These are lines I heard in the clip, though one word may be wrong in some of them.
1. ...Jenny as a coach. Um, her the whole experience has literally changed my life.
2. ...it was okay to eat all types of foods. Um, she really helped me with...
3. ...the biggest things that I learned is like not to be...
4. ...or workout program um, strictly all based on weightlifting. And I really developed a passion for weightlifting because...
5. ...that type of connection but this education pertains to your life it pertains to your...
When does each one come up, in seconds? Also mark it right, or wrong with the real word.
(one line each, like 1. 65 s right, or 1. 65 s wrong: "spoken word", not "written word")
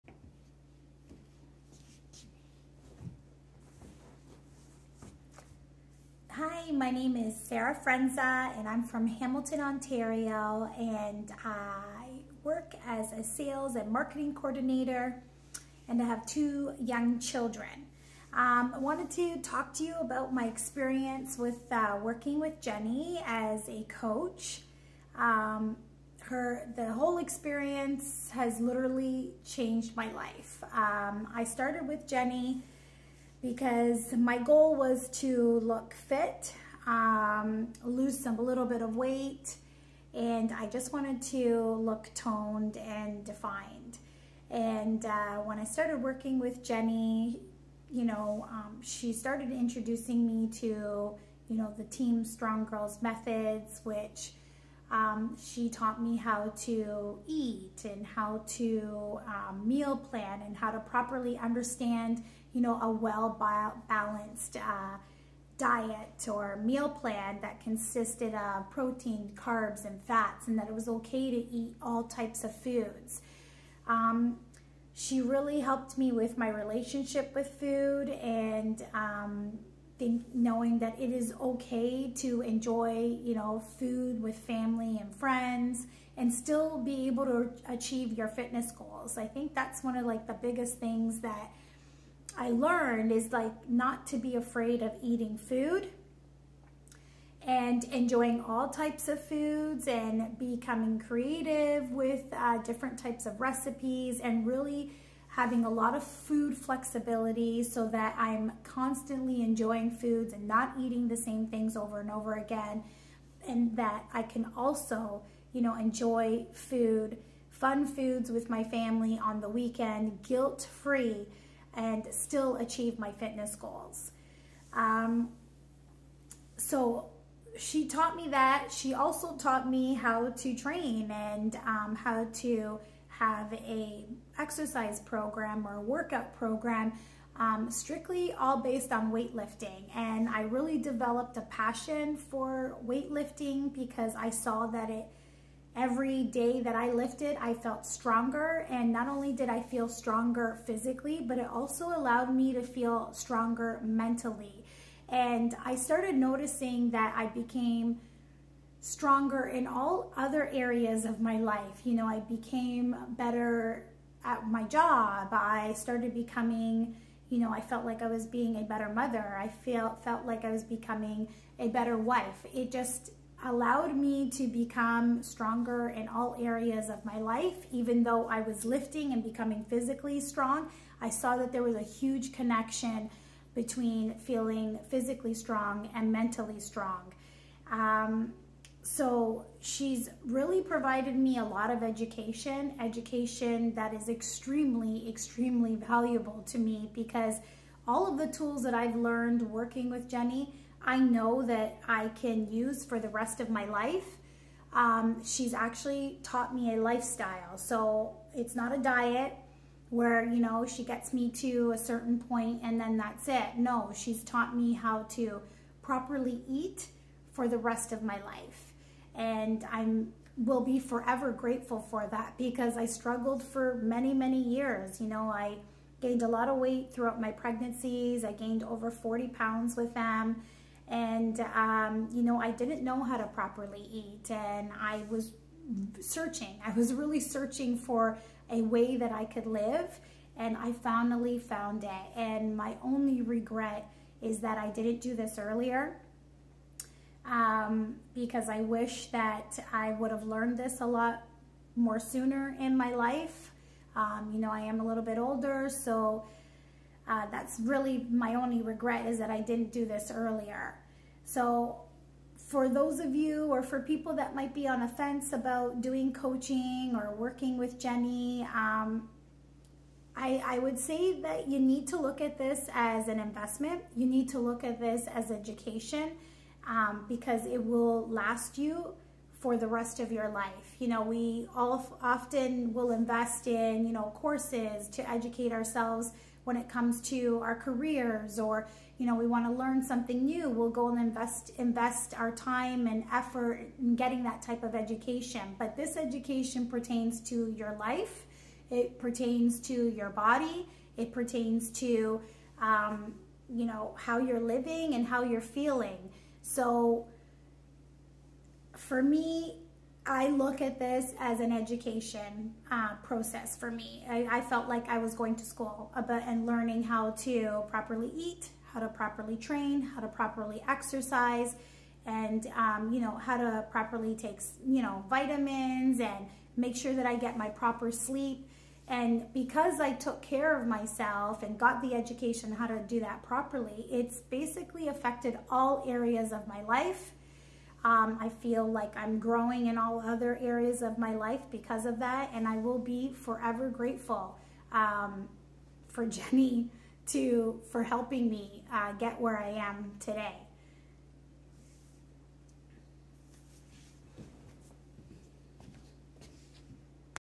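1. 22 s right
2. 70 s right
3. 90 s right
4. 135 s right
5. 294 s wrong: "education", not "connection".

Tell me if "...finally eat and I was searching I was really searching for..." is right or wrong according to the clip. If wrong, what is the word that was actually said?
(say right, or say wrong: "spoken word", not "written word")
wrong: "properly", not "finally".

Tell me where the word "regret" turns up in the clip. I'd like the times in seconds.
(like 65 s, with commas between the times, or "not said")
243 s, 258 s.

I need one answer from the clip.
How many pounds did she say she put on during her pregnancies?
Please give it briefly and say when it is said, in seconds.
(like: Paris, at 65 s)
over 40, at 228 s.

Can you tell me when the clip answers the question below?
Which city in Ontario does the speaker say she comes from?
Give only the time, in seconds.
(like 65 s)
9 s.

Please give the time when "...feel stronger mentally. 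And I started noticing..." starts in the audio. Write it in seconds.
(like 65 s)
152 s.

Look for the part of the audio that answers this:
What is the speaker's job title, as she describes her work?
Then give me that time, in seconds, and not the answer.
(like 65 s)
13 s.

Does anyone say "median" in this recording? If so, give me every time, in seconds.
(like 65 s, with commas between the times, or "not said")
not said.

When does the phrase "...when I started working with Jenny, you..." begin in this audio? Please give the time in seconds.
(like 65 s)
45 s.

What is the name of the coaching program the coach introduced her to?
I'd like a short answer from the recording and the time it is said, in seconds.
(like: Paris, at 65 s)
Team Strong Girls, at 51 s.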